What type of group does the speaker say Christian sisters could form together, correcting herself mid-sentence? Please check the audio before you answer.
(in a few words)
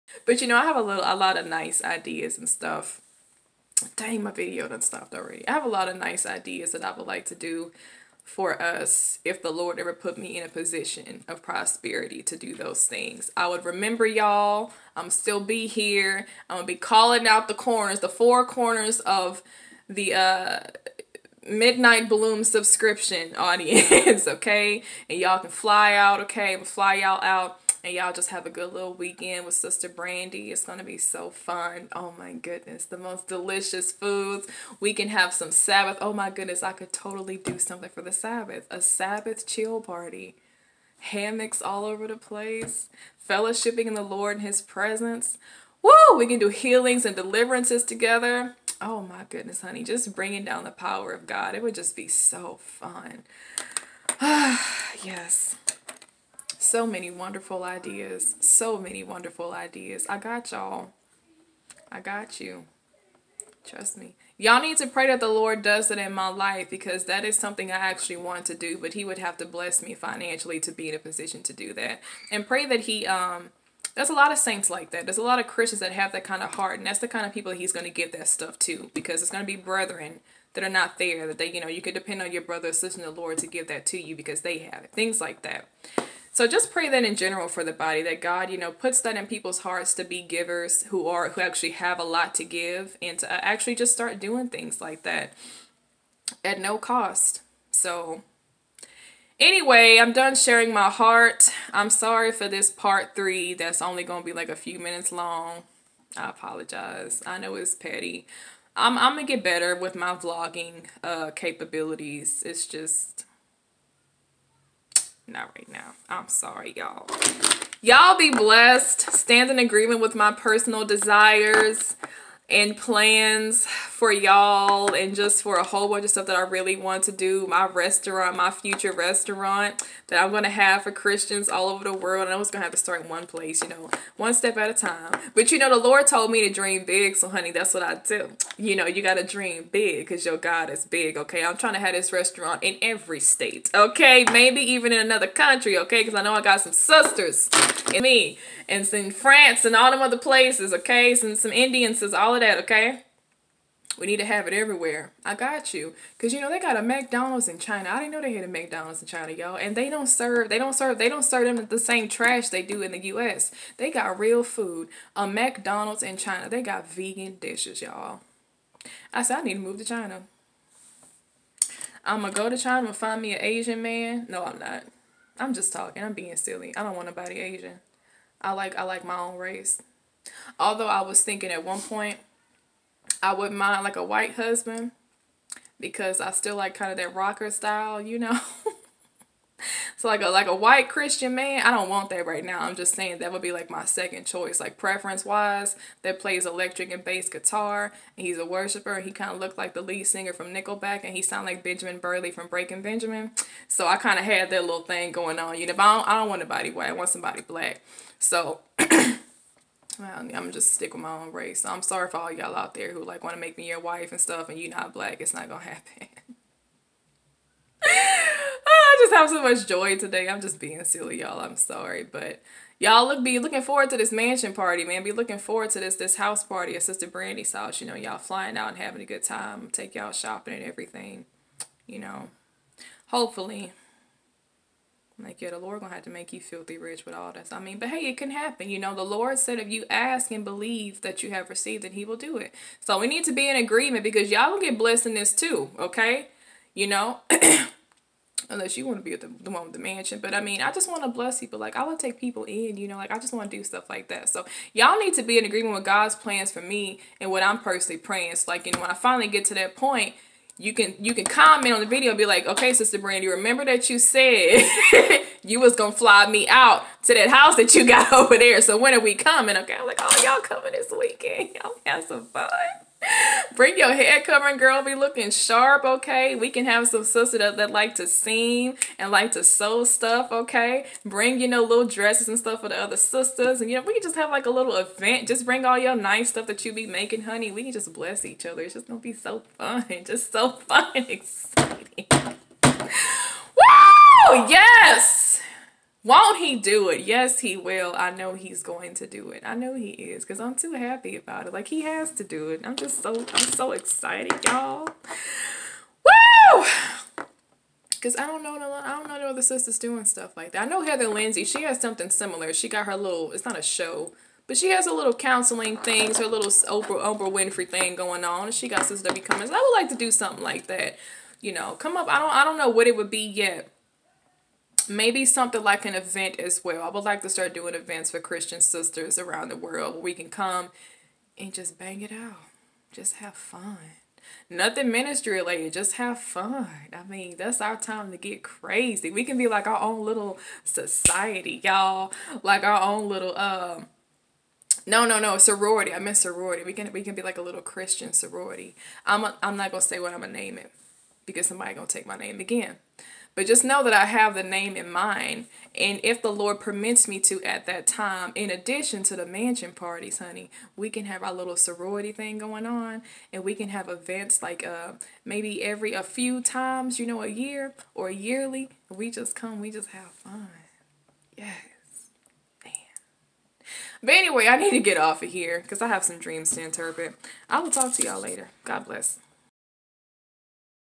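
Christian sorority.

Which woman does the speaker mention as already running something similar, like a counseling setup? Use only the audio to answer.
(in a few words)
Heather Lindsey.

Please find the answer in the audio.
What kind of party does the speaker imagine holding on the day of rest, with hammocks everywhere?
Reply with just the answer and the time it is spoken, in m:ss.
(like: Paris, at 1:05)
Sabbath chill party, at 0:38.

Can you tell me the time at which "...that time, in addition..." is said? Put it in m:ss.
5:57.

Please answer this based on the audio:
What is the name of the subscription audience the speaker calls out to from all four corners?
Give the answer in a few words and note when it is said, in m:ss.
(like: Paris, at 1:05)
Midnight Bloom, at 0:21.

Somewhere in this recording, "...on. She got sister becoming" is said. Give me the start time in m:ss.
5:18.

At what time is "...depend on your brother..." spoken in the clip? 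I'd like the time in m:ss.
1:21.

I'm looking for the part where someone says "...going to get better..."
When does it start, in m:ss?
1:49.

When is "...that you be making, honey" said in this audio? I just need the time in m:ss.
4:46.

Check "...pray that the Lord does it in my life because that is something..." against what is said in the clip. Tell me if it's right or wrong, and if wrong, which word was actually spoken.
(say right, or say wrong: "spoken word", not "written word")
right.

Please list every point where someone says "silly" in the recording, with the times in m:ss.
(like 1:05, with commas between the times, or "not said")
2:56, 3:40.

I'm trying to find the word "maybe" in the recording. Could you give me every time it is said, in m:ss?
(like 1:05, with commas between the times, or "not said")
2:24, 5:24, 6:05.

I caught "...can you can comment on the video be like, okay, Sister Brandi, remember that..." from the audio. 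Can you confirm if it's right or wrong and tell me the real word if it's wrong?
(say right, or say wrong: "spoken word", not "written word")
right.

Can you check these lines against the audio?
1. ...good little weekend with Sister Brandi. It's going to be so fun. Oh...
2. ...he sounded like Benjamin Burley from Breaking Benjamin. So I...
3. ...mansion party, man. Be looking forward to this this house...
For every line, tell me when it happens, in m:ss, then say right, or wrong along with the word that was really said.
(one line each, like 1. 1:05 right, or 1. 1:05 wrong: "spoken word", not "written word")
1. 0:28 right
2. 3:21 right
3. 3:44 right.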